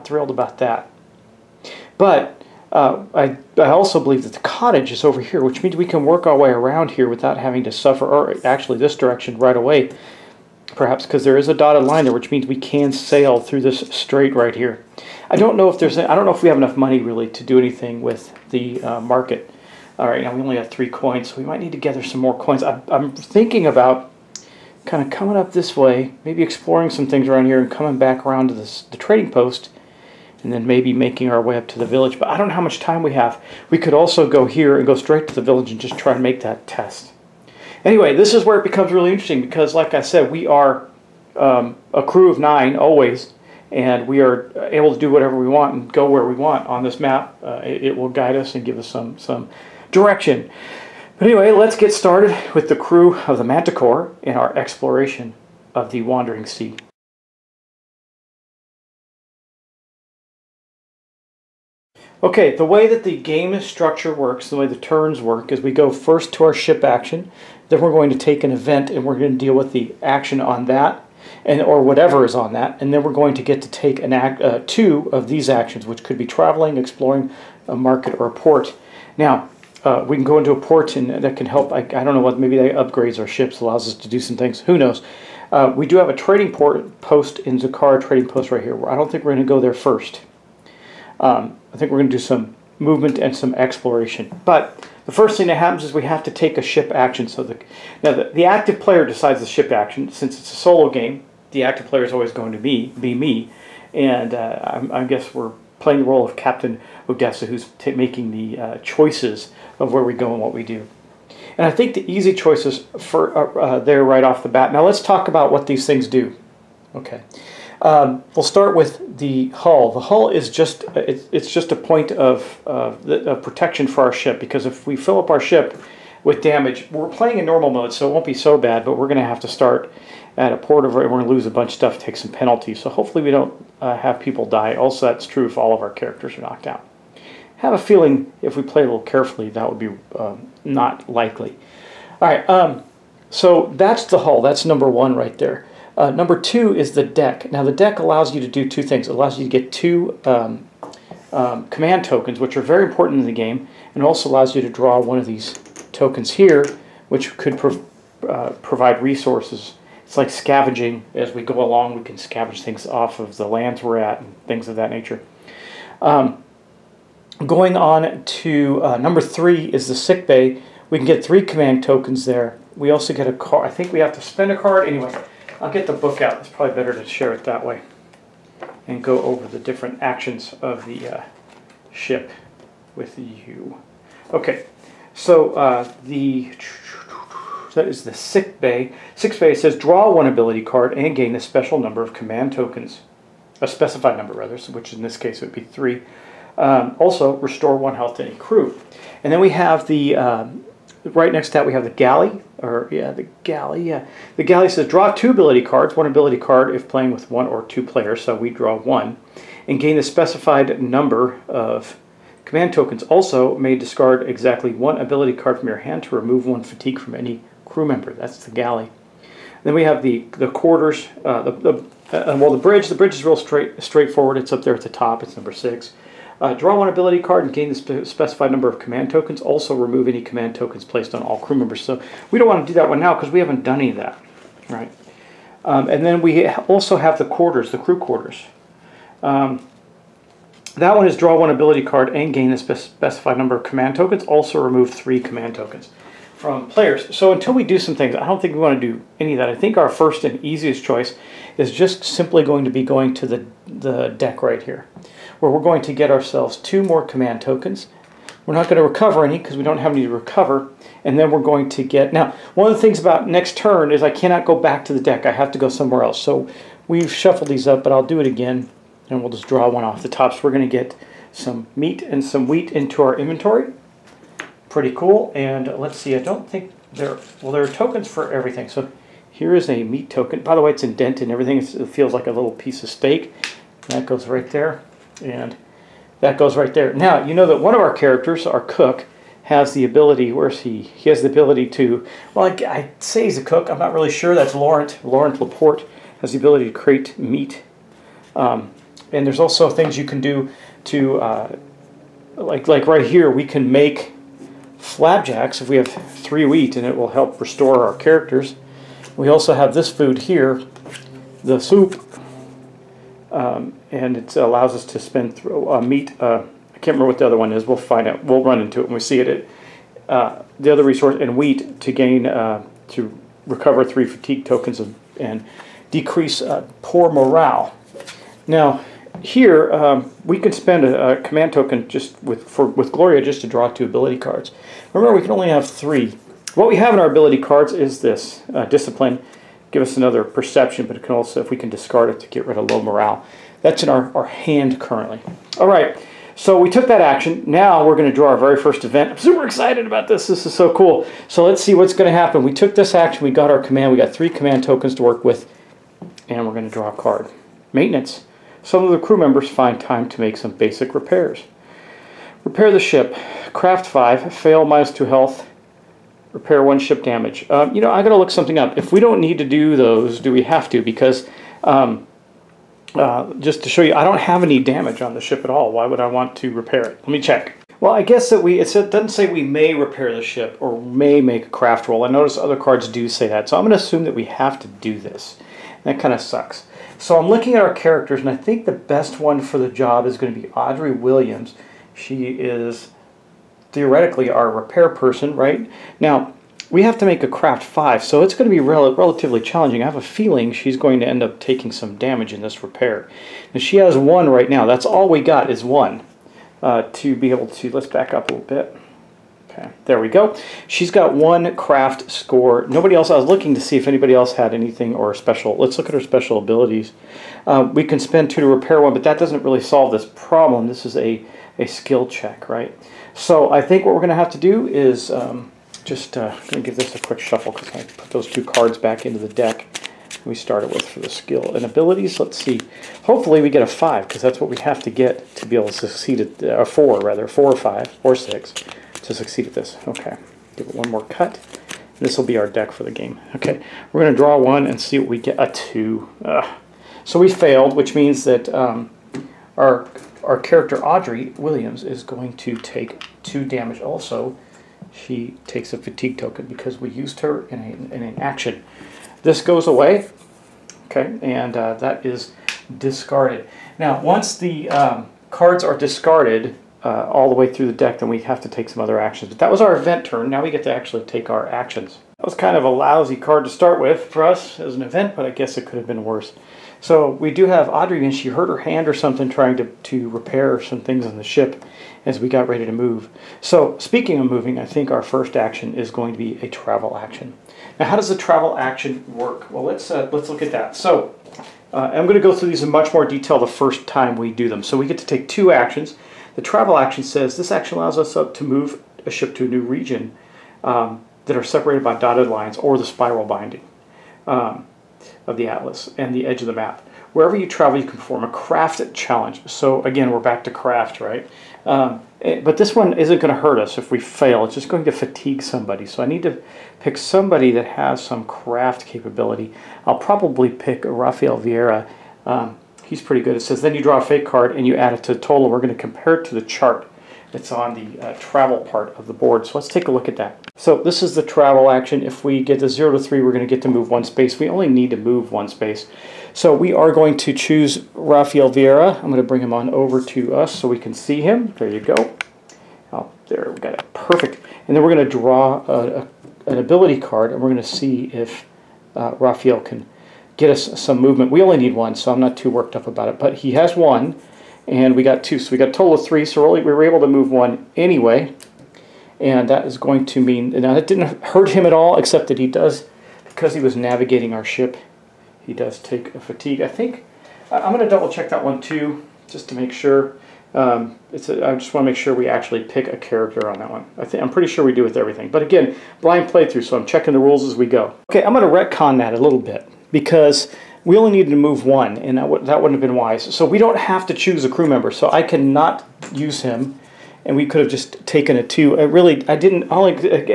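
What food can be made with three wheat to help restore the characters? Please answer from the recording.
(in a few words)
Flapjacks.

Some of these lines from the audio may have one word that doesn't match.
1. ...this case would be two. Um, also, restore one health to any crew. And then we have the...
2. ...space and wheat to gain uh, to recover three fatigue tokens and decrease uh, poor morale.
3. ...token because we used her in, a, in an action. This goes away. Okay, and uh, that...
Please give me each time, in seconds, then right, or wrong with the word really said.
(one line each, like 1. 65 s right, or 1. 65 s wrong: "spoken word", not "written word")
1. 195 s wrong: "three", not "two"
2. 320 s wrong: "resource", not "space"
3. 456 s right.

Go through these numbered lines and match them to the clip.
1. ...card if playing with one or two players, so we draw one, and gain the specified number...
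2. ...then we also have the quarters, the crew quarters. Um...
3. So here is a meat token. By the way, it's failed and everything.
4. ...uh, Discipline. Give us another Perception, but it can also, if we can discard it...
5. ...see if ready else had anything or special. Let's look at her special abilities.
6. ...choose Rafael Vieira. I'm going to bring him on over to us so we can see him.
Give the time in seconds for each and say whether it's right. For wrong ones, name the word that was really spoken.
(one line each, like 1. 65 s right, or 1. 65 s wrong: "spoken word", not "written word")
1. 206 s right
2. 236 s right
3. 278 s wrong: "indented", not "failed"
4. 338 s right
5. 413 s wrong: "anybody", not "ready"
6. 537 s right.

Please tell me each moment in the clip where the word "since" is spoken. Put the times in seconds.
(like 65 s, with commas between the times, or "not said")
100 s.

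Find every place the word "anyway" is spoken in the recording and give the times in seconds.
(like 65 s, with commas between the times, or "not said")
37 s, 51 s, 174 s, 557 s.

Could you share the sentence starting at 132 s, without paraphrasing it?
So hopefully we don't uh, have people die.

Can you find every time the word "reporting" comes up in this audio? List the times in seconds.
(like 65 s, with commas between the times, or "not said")
not said.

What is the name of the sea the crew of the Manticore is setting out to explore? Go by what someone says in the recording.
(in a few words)
Wandering Sea.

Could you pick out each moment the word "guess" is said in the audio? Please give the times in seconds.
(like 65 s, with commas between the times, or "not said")
105 s, 378 s, 475 s.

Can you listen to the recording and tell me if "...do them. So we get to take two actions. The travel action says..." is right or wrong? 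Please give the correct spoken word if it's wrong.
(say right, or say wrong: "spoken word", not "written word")
right.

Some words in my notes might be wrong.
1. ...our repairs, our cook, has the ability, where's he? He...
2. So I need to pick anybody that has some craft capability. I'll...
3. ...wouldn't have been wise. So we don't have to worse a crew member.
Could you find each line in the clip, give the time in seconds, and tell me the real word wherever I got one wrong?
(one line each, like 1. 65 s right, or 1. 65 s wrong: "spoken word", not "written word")
1. 287 s wrong: "characters", not "repairs"
2. 515 s wrong: "somebody", not "anybody"
3. 582 s wrong: "choose", not "worse".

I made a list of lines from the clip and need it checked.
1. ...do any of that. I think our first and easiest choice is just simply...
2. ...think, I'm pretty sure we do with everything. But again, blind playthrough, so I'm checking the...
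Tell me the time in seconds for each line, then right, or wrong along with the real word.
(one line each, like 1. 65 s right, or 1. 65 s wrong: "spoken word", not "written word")
1. 248 s right
2. 574 s right.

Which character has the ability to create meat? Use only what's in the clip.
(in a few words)
Laurent Laporte.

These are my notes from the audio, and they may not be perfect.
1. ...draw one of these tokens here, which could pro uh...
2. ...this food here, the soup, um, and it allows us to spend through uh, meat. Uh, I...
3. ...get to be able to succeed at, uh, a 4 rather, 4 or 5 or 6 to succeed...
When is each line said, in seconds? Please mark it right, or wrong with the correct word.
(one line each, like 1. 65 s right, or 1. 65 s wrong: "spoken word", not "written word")
1. 154 s right
2. 309 s right
3. 434 s right.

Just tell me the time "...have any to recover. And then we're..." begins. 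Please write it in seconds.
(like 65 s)
259 s.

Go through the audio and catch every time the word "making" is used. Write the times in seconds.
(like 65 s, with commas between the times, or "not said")
30 s, 107 s.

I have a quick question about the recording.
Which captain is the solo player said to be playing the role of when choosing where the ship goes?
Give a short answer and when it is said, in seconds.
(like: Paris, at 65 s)
Captain Odessa, at 106 s.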